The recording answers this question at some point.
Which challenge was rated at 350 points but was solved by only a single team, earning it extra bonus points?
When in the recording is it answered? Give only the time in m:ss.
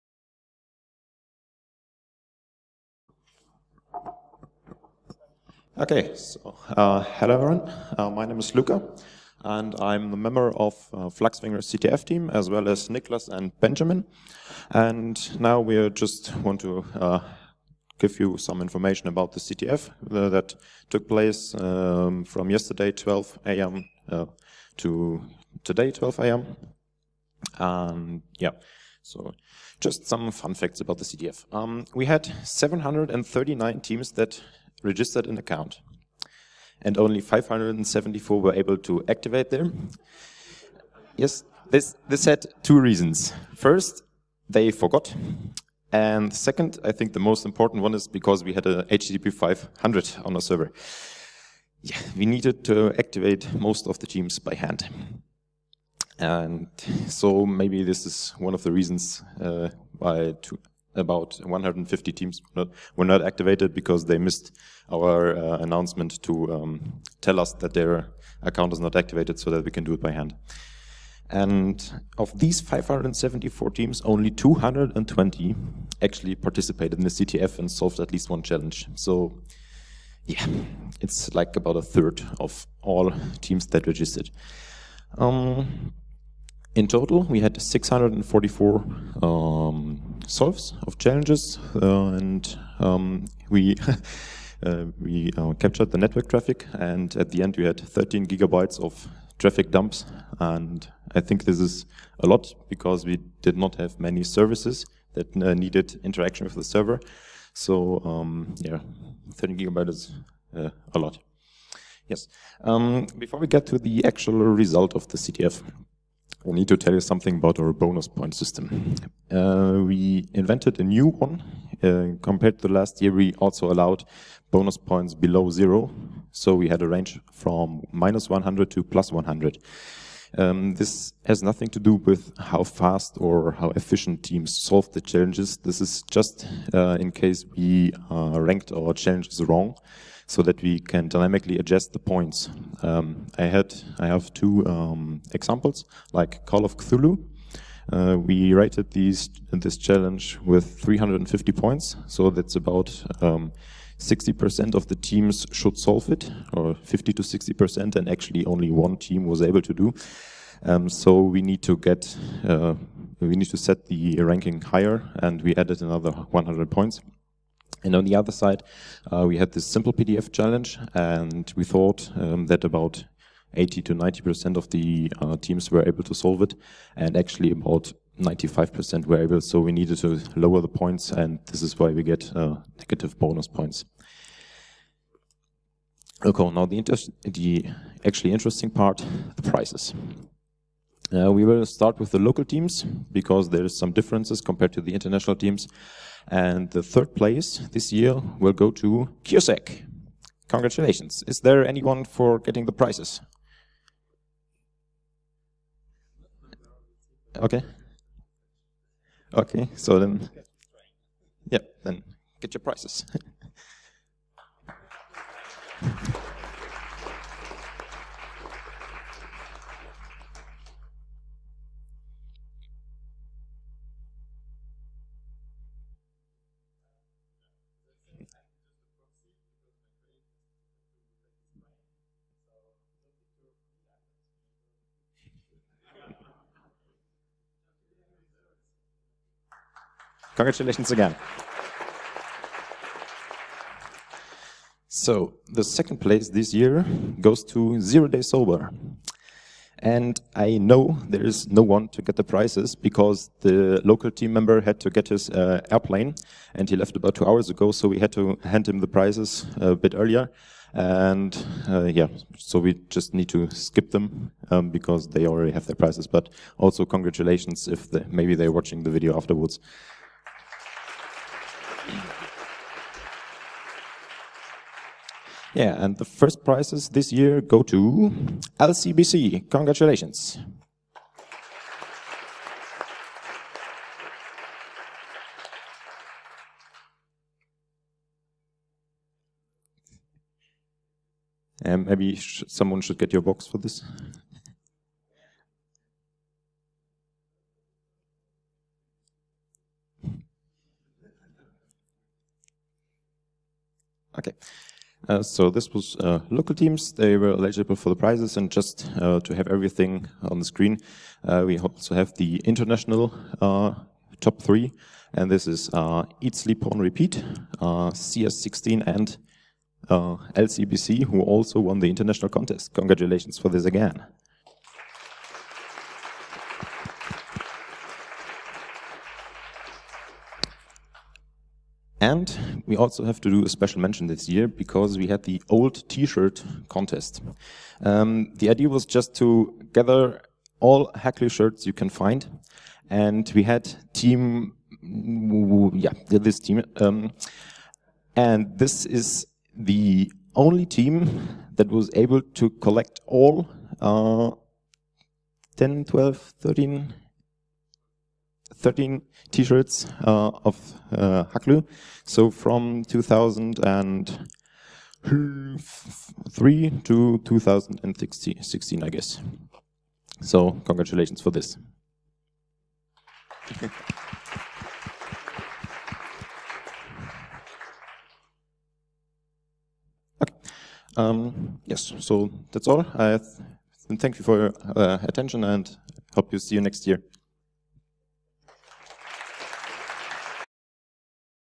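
2:26.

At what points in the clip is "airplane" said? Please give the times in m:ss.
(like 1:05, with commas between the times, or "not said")
4:15.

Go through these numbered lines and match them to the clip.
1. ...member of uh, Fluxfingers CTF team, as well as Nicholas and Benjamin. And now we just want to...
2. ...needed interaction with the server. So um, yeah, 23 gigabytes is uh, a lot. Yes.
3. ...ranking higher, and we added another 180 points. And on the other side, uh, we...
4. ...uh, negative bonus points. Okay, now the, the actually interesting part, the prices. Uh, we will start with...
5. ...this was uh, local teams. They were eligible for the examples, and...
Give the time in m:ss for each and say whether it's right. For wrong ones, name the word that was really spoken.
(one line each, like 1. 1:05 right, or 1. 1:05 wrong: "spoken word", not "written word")
1. 0:10 right
2. 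1:45 wrong: "13", not "23"
3. 2:44 wrong: "100", not "180"
4. 3:02 right
5. 5:05 wrong: "prizes", not "examples".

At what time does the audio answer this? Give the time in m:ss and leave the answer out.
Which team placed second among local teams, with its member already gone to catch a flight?
4:07.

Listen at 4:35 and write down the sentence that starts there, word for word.
Yeah, and the first prizes this year go to LCBC.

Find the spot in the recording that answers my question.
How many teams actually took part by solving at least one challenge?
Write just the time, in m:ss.
1:14.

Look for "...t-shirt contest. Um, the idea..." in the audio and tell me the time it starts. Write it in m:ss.
5:35.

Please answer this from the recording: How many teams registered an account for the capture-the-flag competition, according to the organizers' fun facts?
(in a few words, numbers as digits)
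739.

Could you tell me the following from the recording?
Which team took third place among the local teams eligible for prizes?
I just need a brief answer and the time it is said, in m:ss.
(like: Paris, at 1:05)
CureSec, at 3:19.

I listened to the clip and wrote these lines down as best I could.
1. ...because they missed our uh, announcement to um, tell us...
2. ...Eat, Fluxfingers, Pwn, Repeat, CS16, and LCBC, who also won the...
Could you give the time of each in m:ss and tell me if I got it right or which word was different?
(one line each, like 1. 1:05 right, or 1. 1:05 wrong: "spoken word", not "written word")
1. 1:03 right
2. 5:16 wrong: "Sleep", not "Fluxfingers".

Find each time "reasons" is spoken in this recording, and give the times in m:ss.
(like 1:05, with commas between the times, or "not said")
0:42, 0:58.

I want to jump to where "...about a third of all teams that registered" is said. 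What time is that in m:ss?
1:21.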